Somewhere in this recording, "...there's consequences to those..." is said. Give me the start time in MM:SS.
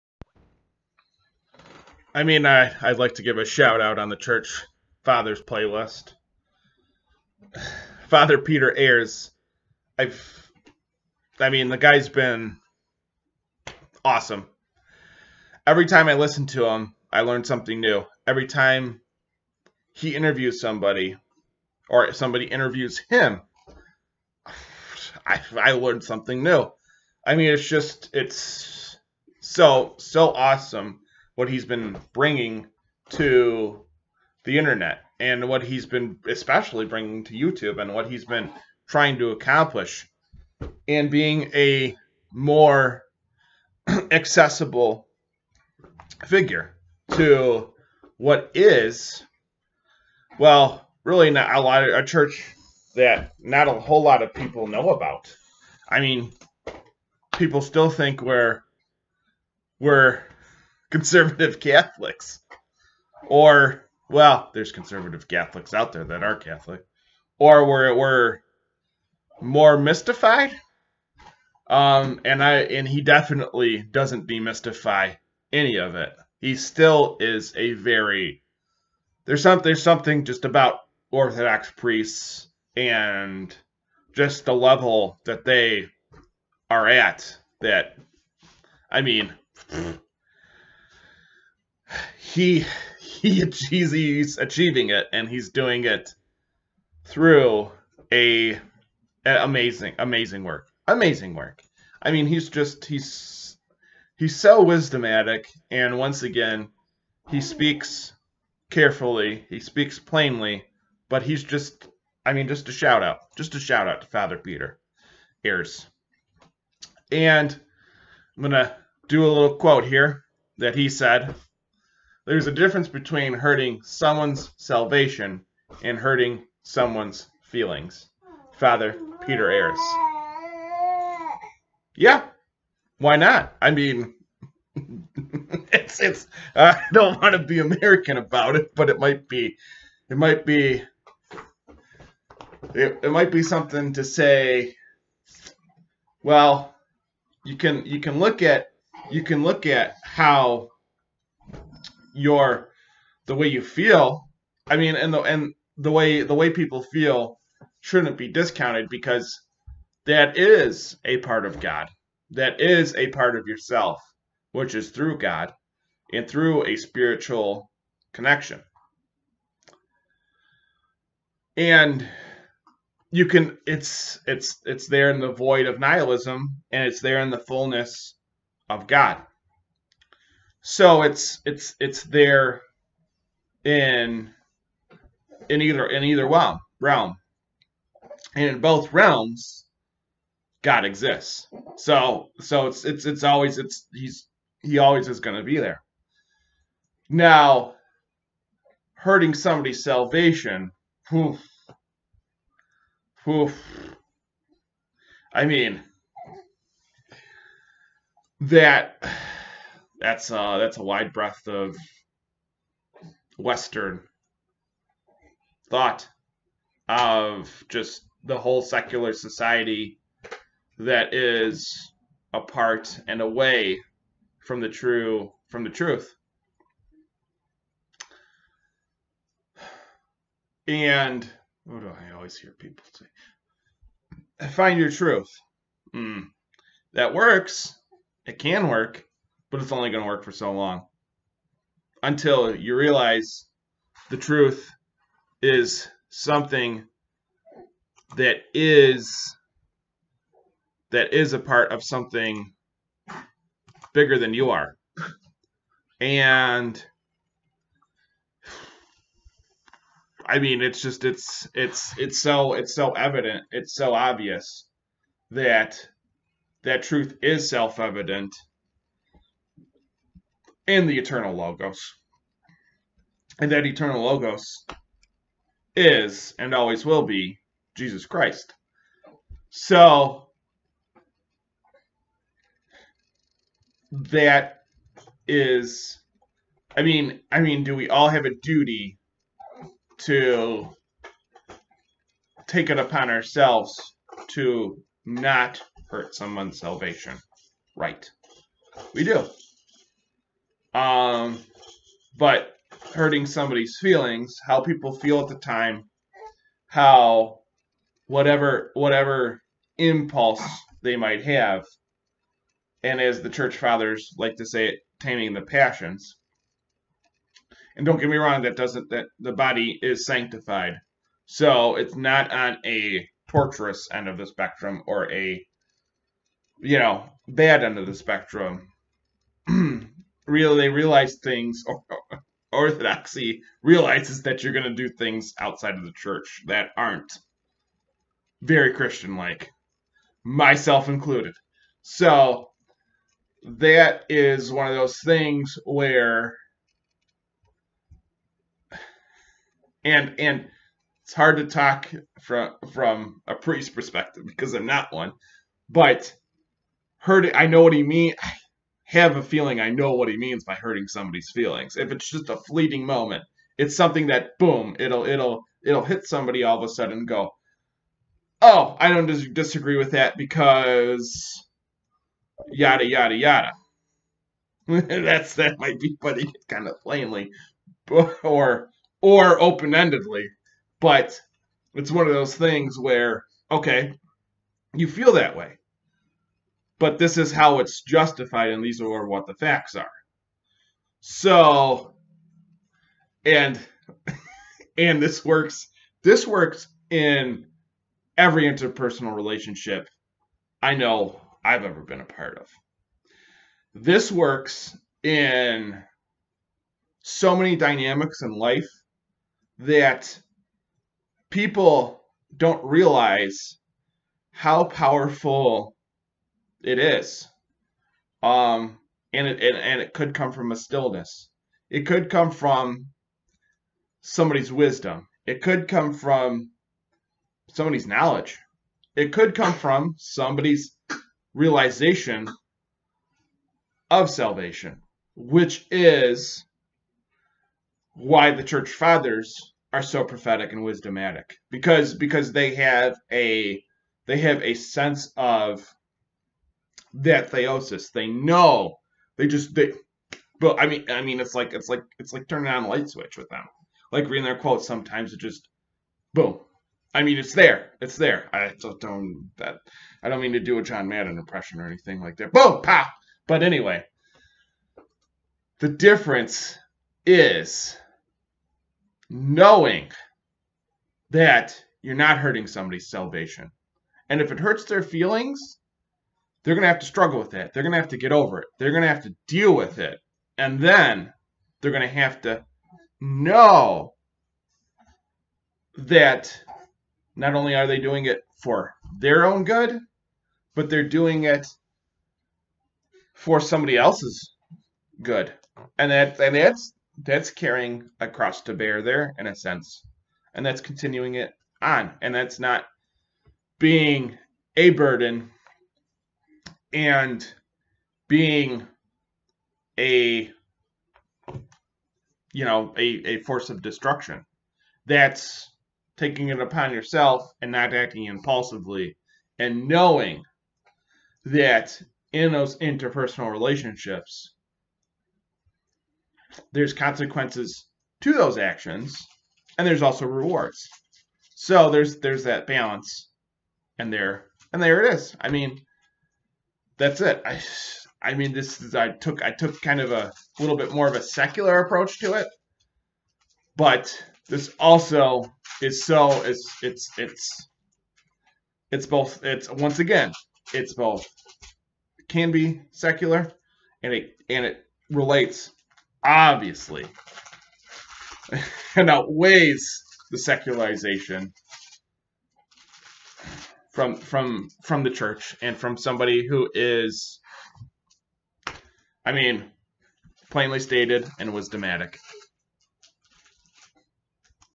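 08:46.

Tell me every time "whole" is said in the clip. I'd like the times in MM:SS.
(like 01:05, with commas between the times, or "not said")
00:53, 03:38.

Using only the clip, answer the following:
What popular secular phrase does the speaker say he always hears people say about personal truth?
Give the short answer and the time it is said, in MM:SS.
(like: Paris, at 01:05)
Find your truth, at 03:54.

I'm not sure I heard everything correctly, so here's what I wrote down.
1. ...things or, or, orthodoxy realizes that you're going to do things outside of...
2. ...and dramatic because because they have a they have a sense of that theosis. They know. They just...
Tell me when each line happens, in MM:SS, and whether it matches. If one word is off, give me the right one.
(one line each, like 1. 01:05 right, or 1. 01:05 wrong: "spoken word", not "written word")
1. 05:31 right
2. 07:20 wrong: "wisdomatic", not "dramatic".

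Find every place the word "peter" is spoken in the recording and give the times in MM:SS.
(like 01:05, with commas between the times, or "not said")
00:08, 01:54, 02:09.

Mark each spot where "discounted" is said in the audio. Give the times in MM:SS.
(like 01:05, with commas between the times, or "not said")
02:38.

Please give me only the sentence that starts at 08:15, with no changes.
And that and that's that's carrying a cross to bear there in a sense.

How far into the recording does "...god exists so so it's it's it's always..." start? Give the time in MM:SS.
03:10.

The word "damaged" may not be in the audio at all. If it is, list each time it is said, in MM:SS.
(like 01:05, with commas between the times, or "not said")
not said.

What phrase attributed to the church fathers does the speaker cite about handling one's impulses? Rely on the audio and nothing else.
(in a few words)
Taming the passions.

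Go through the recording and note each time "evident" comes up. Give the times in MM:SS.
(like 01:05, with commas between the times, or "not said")
04:22, 04:27.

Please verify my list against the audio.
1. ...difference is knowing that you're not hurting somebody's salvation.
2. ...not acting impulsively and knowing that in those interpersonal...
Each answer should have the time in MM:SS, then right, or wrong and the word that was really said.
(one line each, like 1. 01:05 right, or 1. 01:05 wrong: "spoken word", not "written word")
1. 07:45 right
2. 08:37 right.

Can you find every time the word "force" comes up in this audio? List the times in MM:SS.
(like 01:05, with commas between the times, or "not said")
08:33.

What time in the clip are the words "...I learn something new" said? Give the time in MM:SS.
00:17.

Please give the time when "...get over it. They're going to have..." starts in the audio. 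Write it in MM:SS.
07:57.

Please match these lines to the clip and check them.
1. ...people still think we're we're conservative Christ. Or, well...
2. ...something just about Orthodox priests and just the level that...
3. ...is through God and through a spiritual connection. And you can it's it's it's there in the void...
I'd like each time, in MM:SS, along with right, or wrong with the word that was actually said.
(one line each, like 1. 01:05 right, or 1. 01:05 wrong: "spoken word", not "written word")
1. 00:57 wrong: "Catholics", not "Christ"
2. 01:19 right
3. 02:44 right.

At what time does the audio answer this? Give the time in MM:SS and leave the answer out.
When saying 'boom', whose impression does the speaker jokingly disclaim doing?
07:40.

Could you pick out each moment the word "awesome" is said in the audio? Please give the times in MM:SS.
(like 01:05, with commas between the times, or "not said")
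00:14, 00:30.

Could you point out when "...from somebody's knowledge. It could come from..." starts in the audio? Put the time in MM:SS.
07:05.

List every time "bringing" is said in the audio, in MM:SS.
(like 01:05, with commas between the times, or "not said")
00:32, 00:36.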